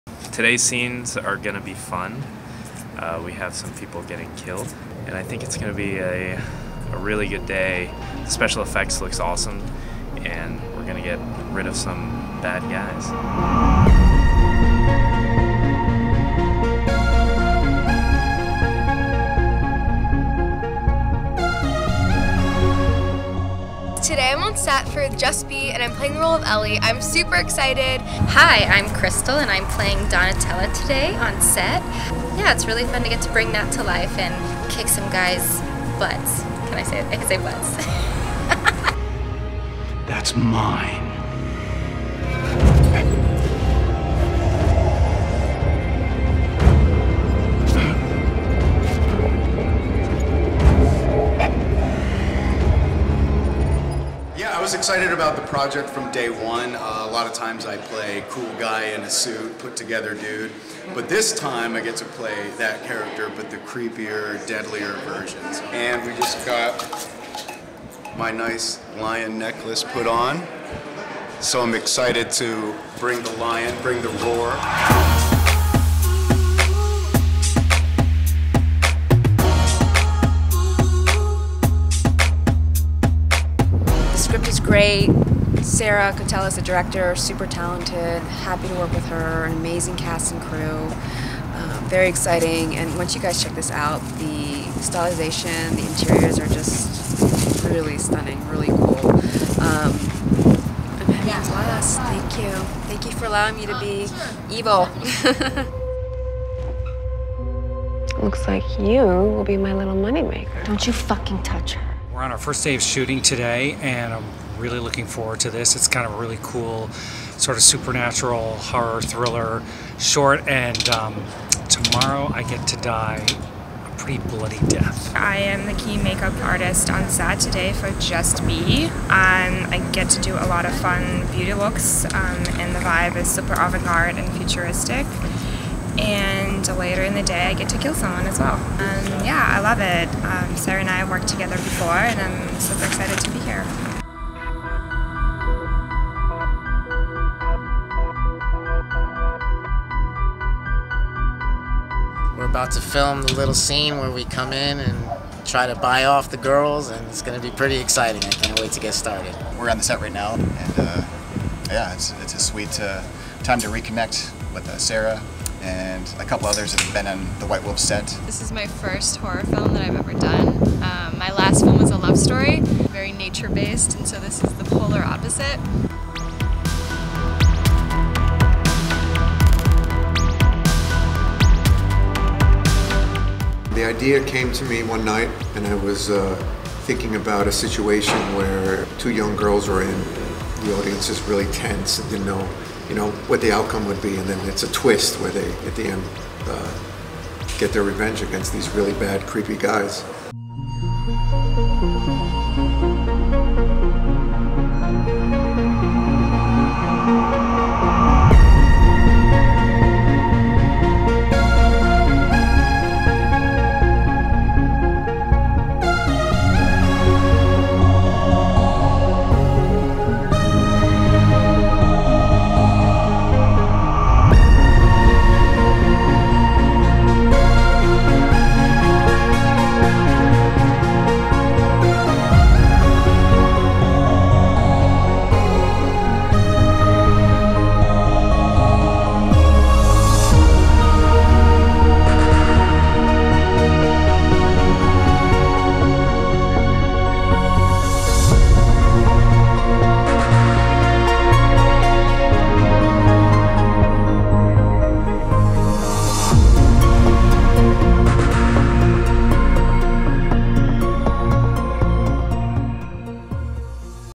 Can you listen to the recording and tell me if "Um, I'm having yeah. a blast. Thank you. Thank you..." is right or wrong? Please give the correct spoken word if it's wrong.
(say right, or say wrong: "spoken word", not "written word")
right.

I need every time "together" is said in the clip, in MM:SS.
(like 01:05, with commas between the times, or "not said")
00:59, 02:21.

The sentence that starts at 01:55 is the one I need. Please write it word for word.
It's kind of a really cool, sort of supernatural horror thriller short.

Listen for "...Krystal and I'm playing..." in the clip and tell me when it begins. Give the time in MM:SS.
00:28.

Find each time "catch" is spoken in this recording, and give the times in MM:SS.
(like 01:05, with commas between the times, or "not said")
not said.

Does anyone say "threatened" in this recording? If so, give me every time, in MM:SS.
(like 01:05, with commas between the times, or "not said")
not said.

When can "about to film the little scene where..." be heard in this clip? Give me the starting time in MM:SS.
02:32.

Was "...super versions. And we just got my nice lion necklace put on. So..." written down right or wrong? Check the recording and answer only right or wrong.
wrong.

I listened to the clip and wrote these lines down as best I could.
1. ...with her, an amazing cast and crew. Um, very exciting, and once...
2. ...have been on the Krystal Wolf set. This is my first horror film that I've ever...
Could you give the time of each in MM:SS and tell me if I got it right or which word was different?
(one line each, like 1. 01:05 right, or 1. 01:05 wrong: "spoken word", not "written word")
1. 01:28 right
2. 02:46 wrong: "White", not "Krystal".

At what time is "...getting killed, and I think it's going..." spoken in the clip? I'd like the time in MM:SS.
00:04.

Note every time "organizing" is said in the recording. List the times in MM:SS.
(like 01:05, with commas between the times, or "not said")
not said.